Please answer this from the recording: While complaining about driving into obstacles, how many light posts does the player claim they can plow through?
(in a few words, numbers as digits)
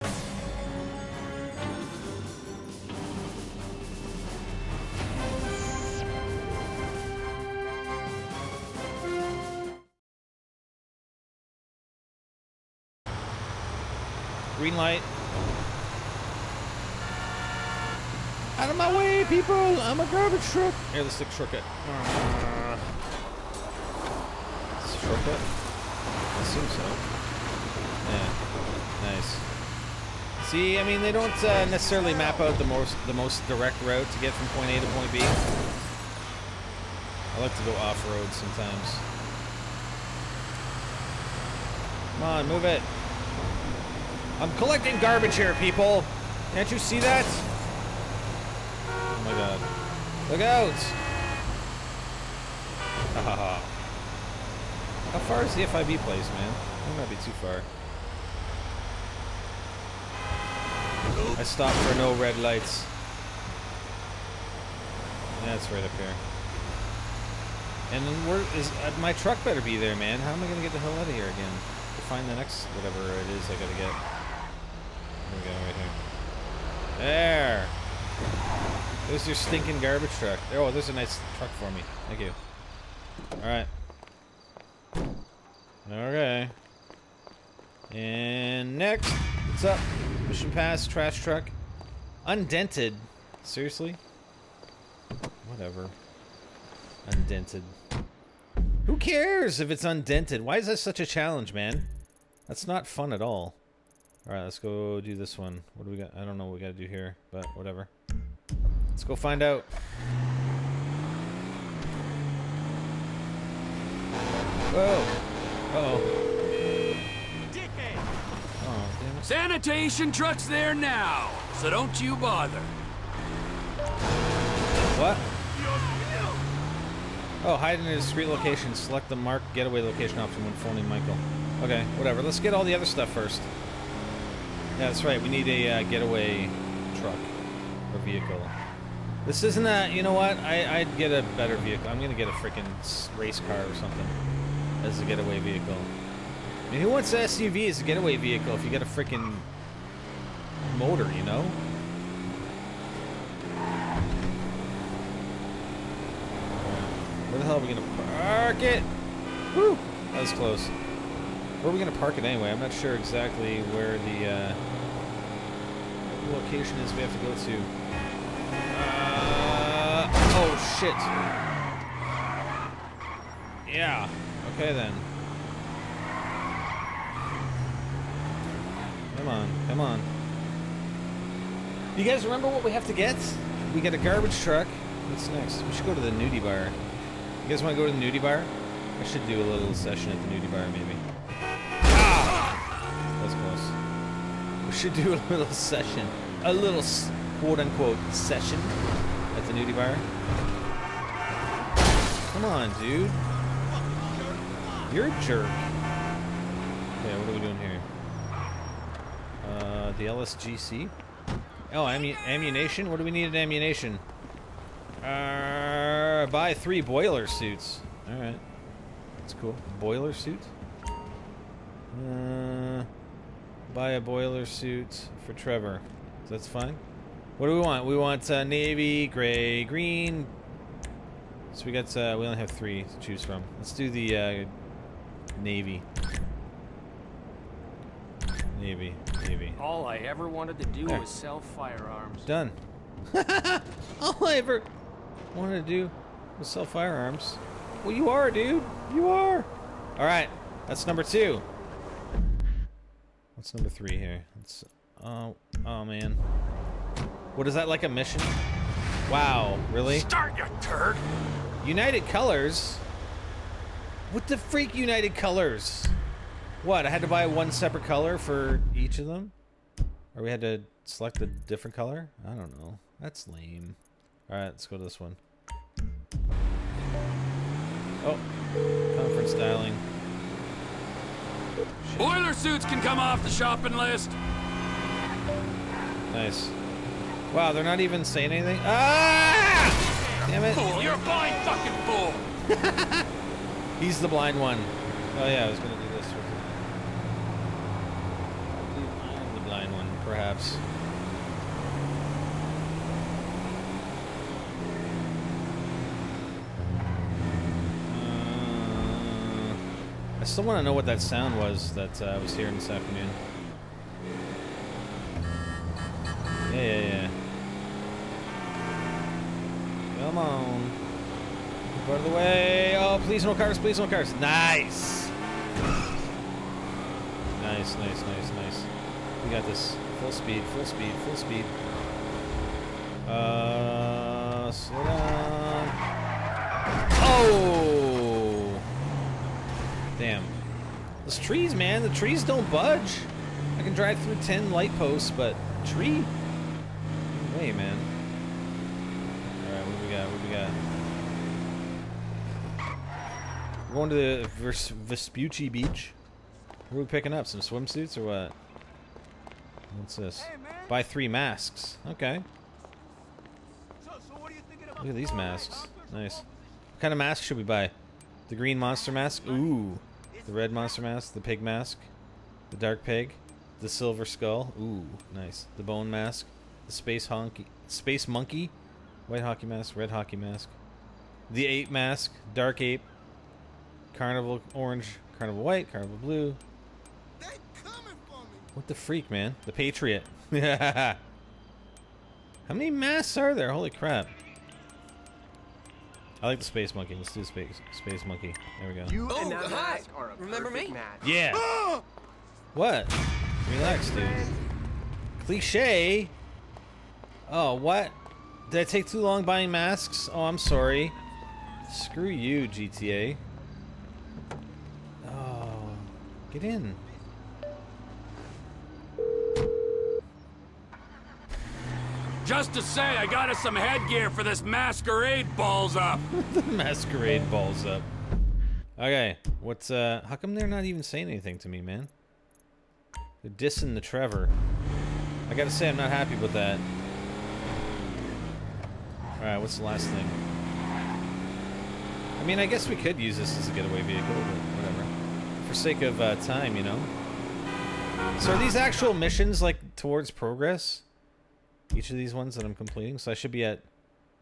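10.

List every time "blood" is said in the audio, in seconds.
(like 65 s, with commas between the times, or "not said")
not said.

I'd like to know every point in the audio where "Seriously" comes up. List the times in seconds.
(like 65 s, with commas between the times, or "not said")
93 s.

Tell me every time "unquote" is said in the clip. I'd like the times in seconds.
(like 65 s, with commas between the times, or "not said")
197 s.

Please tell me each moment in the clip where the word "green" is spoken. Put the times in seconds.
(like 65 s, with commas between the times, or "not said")
14 s, 229 s, 368 s.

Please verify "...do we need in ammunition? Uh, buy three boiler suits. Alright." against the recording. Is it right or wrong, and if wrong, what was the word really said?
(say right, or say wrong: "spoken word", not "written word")
right.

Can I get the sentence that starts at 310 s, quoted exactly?
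still want to know what that sound was that uh, I was hearing this afternoon.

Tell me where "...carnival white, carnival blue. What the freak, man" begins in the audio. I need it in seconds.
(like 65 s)
385 s.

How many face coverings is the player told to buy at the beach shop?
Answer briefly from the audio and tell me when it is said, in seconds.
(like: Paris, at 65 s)
3, at 360 s.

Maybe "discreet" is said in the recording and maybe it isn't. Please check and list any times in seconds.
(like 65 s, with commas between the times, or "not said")
127 s.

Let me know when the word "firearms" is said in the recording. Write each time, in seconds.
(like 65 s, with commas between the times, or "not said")
241 s, 246 s.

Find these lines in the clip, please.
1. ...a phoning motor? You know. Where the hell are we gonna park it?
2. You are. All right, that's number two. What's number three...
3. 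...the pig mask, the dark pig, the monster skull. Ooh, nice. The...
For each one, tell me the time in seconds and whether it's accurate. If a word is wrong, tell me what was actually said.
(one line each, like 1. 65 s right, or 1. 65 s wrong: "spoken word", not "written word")
1. 148 s wrong: "freaking", not "phoning"
2. 248 s right
3. 371 s wrong: "silver", not "monster".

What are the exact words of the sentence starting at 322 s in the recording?
Oh, please no cars, please no cars.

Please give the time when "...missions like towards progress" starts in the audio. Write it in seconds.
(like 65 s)
448 s.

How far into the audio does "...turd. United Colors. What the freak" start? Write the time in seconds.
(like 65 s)
260 s.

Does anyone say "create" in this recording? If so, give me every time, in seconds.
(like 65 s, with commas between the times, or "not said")
not said.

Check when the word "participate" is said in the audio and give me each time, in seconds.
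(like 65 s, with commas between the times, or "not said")
not said.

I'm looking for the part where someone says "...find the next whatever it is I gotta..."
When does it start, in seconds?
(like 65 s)
72 s.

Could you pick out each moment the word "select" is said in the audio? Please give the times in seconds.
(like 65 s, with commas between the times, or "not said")
128 s, 270 s.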